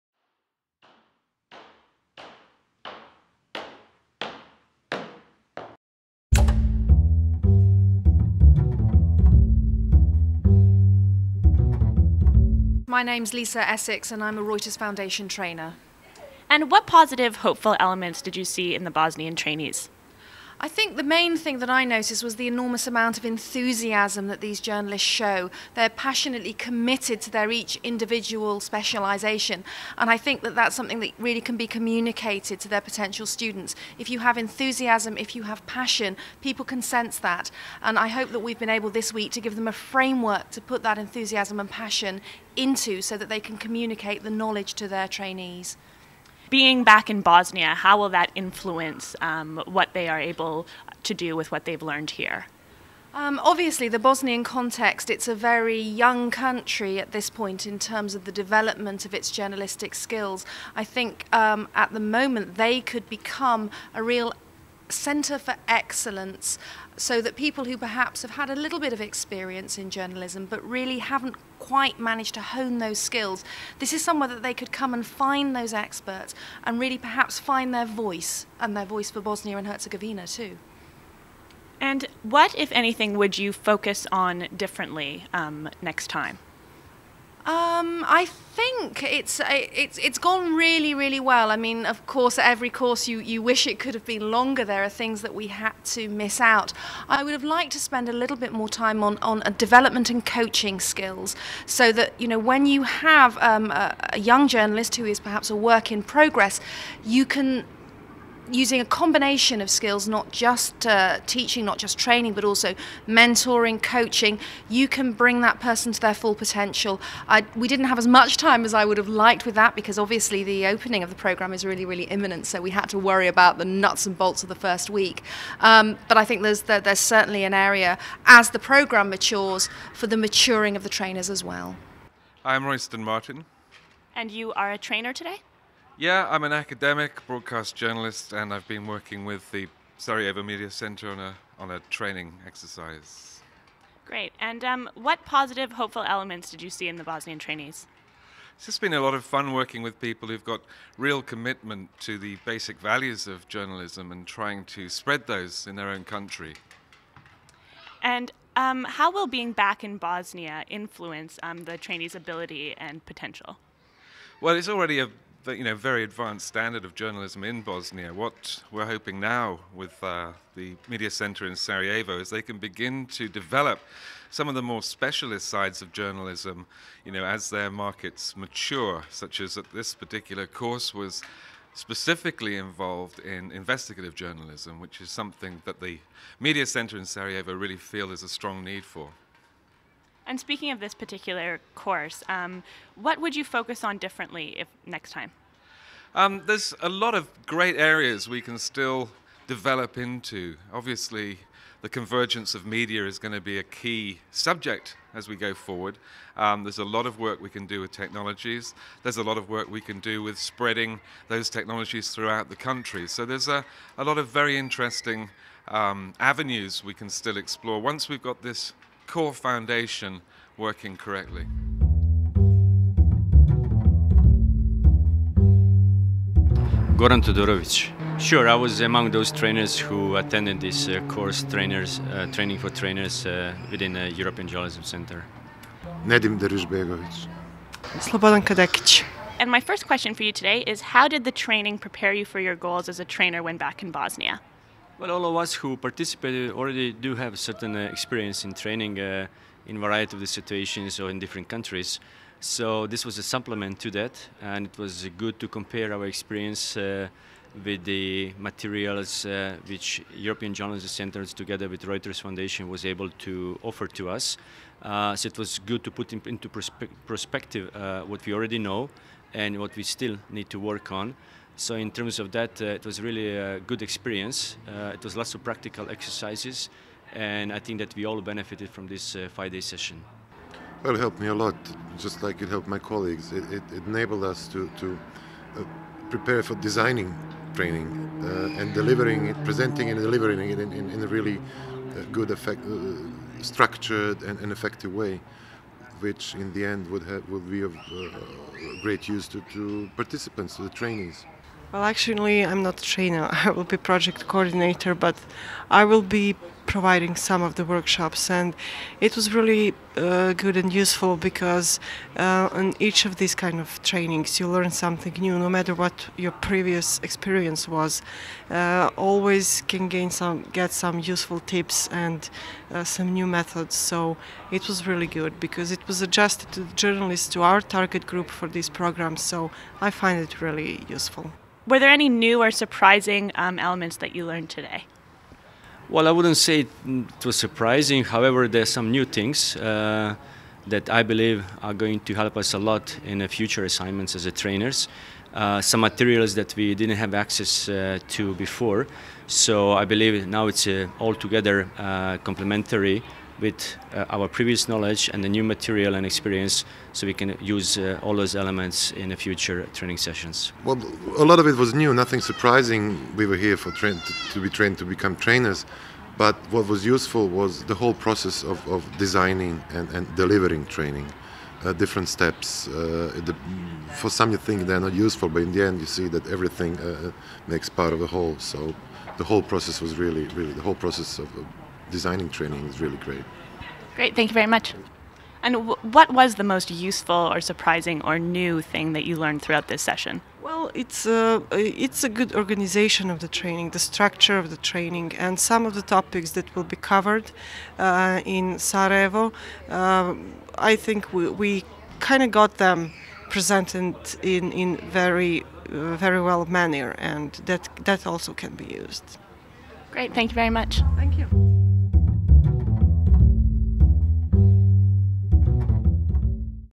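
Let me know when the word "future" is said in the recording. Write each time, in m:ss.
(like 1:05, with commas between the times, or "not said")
5:43, 5:59.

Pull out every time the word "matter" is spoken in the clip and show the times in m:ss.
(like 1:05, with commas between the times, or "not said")
5:15.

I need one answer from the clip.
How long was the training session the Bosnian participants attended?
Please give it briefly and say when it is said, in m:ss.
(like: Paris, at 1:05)
5 days, at 4:39.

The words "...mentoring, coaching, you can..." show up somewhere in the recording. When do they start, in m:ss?
1:53.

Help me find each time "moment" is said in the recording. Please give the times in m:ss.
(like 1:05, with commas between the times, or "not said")
1:01.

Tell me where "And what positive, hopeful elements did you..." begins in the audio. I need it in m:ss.
0:16.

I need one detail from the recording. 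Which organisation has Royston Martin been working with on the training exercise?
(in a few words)
Sarajevo Media Center.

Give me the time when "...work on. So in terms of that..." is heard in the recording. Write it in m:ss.
4:30.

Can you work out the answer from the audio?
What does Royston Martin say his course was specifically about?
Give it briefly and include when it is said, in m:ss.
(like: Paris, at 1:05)
investigative journalism, at 3:03.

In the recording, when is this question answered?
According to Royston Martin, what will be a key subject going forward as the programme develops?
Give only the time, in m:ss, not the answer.
3:21.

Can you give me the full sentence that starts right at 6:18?
So the whole process was really, really, the whole process of designing training is really great.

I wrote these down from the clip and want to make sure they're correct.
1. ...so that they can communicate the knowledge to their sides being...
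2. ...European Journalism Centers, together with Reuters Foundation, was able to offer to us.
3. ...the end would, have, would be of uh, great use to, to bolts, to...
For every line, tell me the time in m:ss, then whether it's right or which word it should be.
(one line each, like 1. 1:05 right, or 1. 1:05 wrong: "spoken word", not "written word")
1. 0:43 wrong: "trainees", not "sides"
2. 4:20 right
3. 4:56 wrong: "participants", not "bolts".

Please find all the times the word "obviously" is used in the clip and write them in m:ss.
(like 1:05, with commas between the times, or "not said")
0:53, 1:59, 3:20.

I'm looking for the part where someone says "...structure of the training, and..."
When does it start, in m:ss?
6:33.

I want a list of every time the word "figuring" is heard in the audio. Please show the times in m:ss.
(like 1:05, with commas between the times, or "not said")
not said.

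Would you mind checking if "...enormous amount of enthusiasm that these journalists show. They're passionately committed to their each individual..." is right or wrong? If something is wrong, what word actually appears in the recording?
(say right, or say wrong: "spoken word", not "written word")
right.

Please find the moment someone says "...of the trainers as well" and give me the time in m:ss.
2:10.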